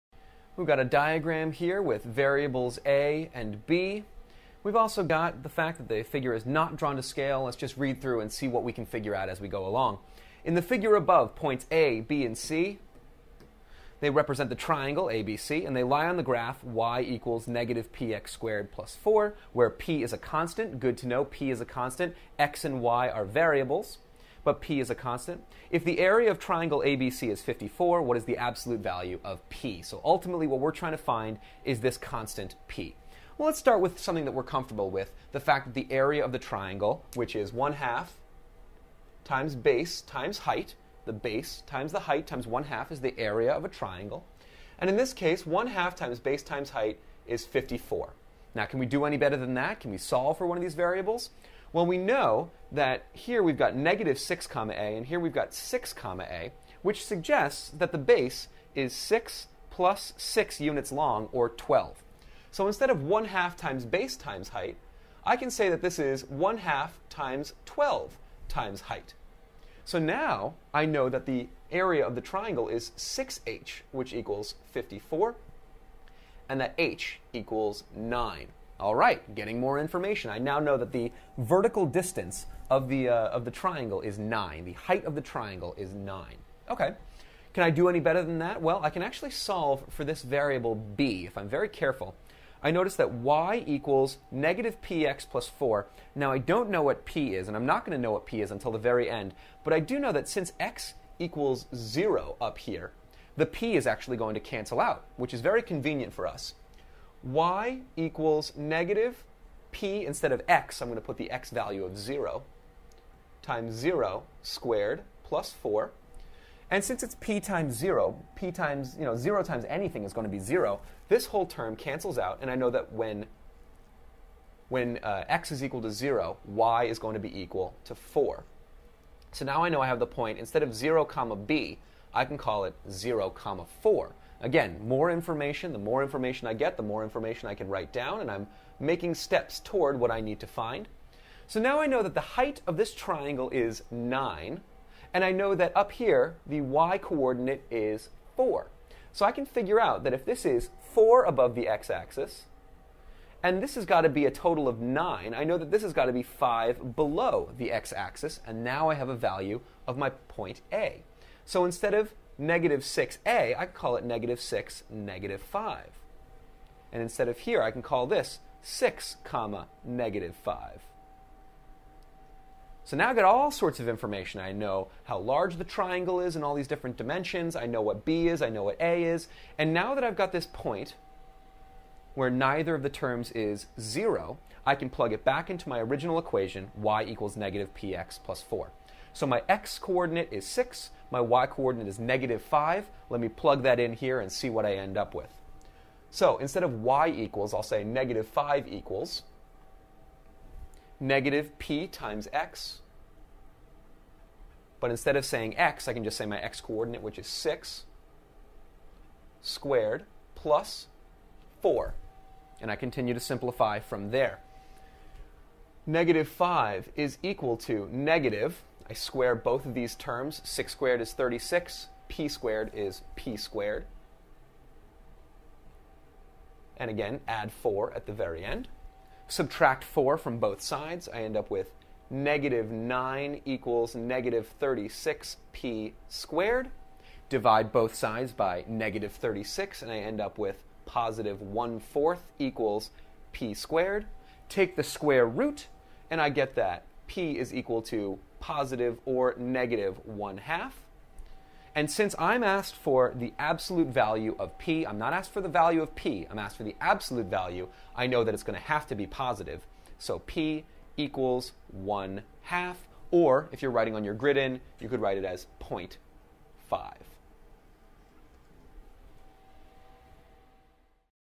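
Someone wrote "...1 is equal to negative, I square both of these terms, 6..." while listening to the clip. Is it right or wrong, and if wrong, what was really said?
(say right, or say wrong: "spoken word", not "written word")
wrong: "5", not "1".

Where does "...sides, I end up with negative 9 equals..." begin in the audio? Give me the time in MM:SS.
03:50.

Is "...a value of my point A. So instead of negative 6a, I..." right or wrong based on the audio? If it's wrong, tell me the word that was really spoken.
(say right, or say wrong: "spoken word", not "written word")
right.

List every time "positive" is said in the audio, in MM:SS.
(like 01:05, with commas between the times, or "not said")
04:00, 04:08, 04:19.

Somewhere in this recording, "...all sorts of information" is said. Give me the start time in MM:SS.
02:53.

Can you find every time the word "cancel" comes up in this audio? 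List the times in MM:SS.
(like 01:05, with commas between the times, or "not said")
01:44, 02:01.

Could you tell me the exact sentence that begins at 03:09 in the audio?
So my x coordinate is 6, my y coordinate is negative 5.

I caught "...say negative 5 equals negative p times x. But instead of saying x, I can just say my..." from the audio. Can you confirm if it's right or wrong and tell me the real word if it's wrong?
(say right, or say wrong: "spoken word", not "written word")
right.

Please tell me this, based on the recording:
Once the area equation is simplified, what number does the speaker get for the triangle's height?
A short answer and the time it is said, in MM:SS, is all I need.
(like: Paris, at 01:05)
9, at 01:16.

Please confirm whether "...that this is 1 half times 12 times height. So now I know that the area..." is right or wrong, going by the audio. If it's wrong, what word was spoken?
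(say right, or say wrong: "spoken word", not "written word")
right.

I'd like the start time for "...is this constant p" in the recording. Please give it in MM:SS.
00:31.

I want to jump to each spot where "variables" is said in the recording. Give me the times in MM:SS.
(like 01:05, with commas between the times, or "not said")
00:02, 00:23, 00:50, 01:30.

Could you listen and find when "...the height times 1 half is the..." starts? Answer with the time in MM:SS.
00:41.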